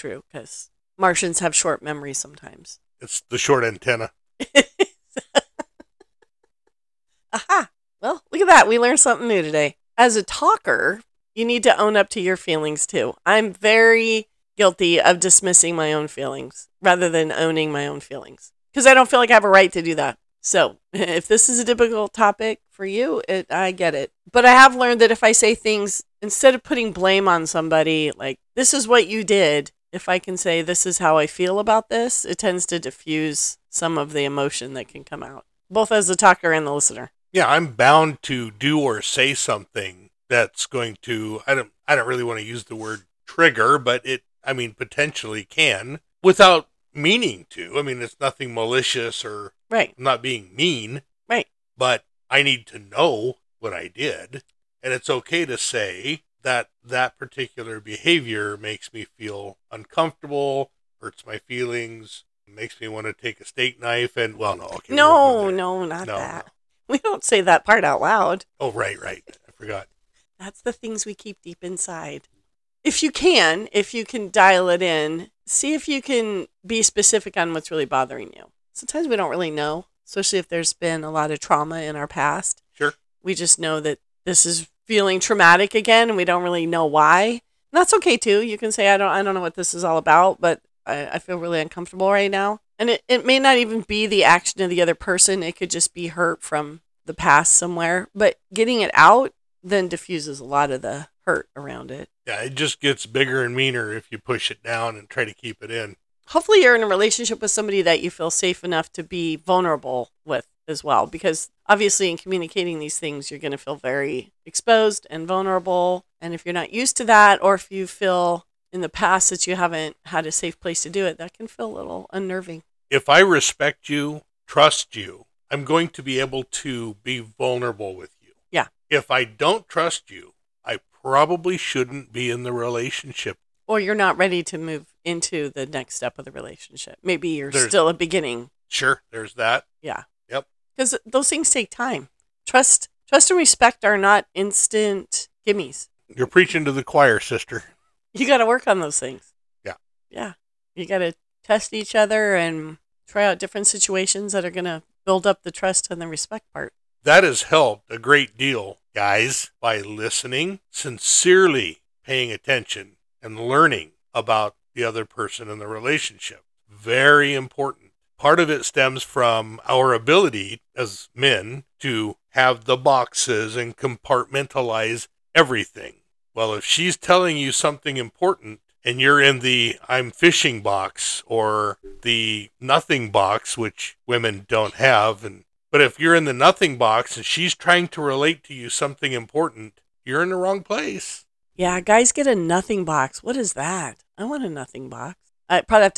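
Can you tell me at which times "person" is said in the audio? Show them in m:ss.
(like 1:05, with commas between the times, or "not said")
1:34, 2:45.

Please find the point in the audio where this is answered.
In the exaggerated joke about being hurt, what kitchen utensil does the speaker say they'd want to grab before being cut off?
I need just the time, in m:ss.
1:03.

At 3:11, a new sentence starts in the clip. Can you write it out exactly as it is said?
Yeah, guys get a nothing box.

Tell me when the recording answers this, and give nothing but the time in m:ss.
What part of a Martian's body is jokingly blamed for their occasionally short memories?
0:03.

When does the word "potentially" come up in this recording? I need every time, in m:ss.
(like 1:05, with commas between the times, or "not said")
0:44.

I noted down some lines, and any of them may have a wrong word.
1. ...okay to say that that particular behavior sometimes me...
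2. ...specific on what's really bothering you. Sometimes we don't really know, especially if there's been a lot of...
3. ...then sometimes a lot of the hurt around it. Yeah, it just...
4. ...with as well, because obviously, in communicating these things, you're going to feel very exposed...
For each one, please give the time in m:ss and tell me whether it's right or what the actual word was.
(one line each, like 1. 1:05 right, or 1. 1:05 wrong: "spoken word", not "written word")
1. 0:55 wrong: "makes", not "sometimes"
2. 1:16 right
3. 1:39 wrong: "diffuses", not "sometimes"
4. 1:50 right.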